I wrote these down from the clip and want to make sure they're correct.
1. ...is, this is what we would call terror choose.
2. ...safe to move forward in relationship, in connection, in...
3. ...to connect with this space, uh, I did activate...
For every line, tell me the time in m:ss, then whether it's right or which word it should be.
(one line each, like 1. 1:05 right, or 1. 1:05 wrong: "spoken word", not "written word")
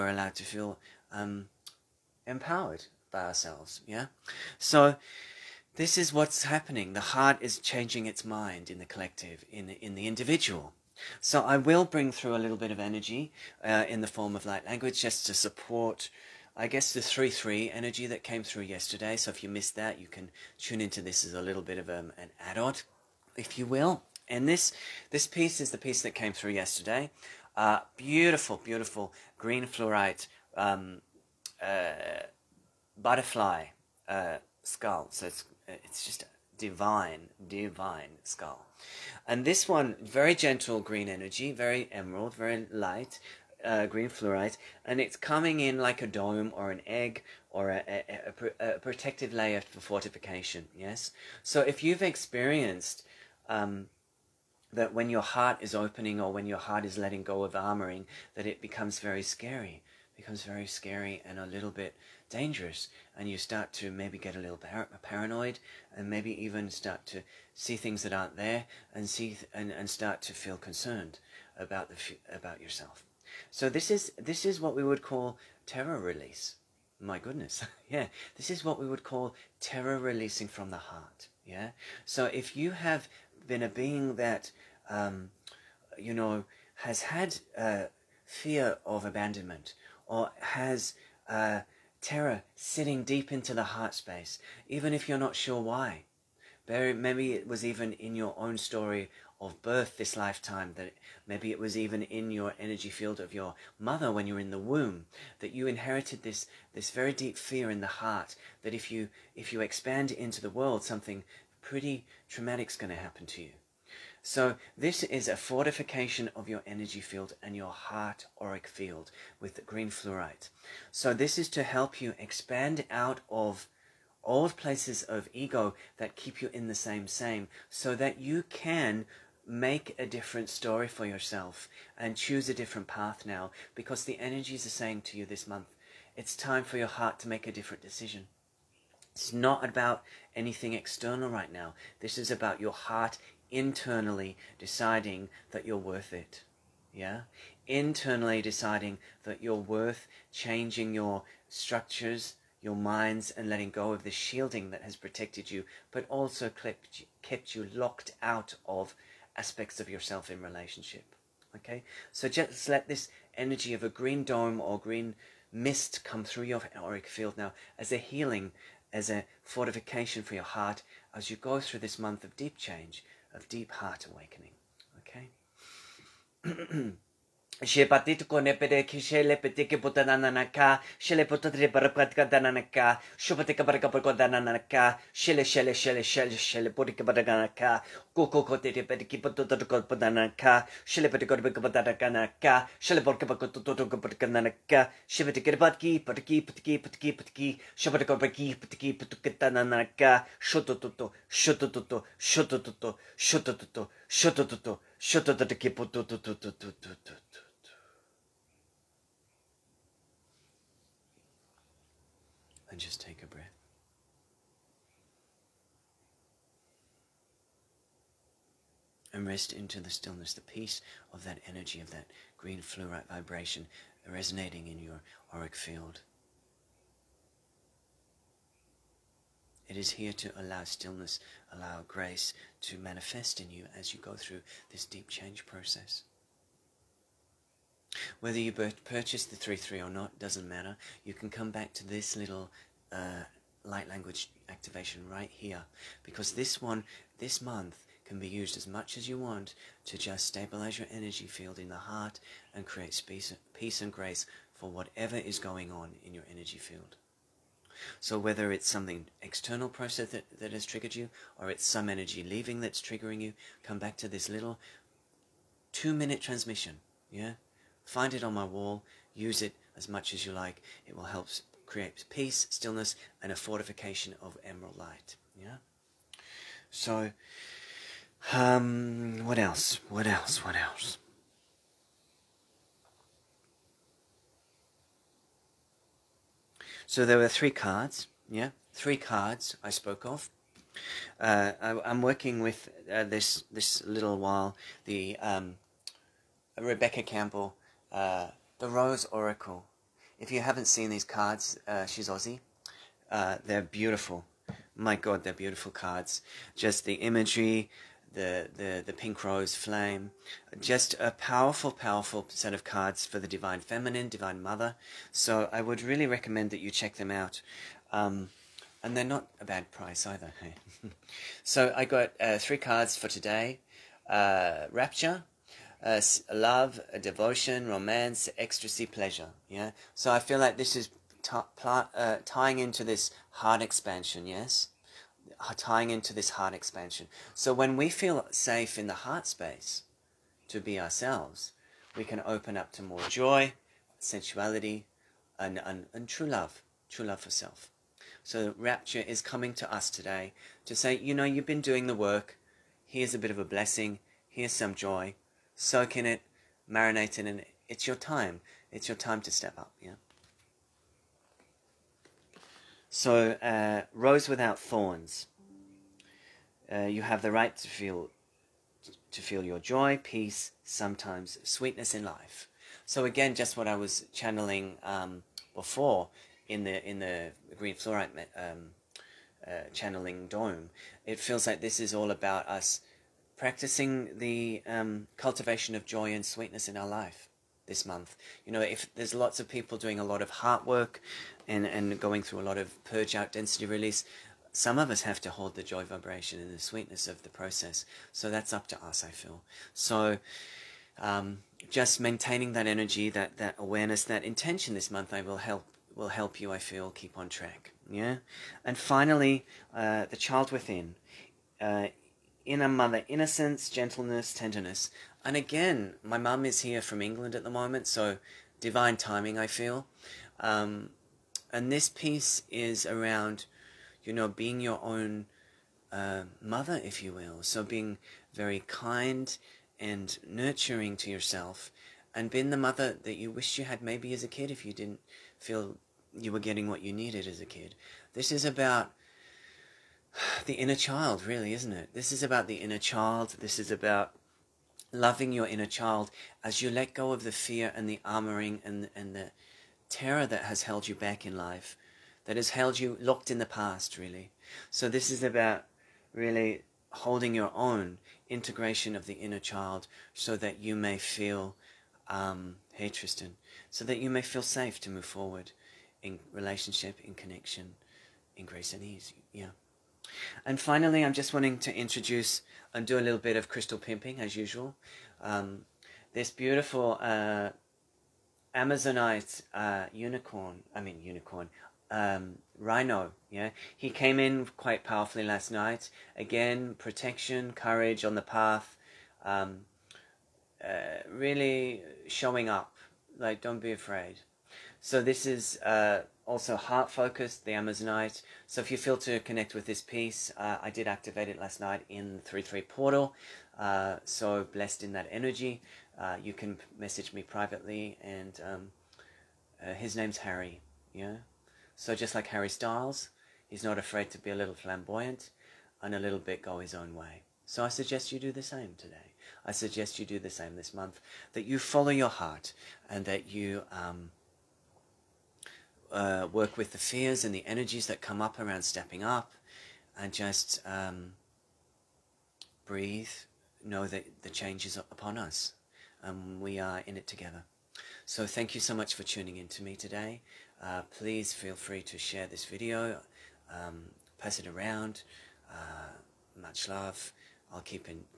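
1. 1:13 wrong: "release", not "choose"
2. 7:44 right
3. 8:18 wrong: "piece", not "space".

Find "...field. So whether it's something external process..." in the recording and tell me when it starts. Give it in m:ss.
4:16.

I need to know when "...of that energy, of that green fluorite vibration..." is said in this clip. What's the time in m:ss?
3:41.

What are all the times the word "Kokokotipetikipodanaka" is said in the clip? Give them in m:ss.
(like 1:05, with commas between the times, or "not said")
3:08.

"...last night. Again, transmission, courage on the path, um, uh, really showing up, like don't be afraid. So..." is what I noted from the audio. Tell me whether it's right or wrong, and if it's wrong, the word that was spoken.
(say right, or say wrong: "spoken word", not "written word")
wrong: "protection", not "transmission".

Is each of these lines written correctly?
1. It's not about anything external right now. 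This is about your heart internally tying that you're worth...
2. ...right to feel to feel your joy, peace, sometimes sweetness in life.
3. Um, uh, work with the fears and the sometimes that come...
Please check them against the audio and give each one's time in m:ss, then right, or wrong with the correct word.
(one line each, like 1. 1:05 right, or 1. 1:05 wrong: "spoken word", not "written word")
1. 2:19 wrong: "deciding", not "tying"
2. 6:07 right
3. 8:43 wrong: "energies", not "sometimes".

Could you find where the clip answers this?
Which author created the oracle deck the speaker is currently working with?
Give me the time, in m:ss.
4:56.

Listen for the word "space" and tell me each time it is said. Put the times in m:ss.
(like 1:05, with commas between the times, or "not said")
1:33, 4:12, 5:39.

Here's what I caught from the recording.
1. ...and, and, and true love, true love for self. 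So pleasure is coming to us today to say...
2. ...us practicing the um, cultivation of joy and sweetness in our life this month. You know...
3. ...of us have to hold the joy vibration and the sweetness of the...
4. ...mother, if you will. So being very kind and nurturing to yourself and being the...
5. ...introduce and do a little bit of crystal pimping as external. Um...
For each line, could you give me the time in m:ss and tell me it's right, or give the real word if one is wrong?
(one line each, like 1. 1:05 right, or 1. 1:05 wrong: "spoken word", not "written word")
1. 5:45 wrong: "rapture", not "pleasure"
2. 6:22 right
3. 6:34 right
4. 7:06 right
5. 7:51 wrong: "usual", not "external".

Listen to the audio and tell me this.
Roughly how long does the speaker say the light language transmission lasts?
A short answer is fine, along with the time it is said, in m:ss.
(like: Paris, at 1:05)
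2 minutes, at 4:25.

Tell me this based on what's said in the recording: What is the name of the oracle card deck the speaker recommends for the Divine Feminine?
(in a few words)
Rose Oracle.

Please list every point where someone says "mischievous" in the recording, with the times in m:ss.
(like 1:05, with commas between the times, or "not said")
not said.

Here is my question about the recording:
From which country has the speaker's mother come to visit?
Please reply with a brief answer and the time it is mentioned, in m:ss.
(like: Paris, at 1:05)
England, at 6:57.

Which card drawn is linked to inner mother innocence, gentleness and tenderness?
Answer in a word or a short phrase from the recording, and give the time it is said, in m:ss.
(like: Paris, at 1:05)
The child within, at 6:50.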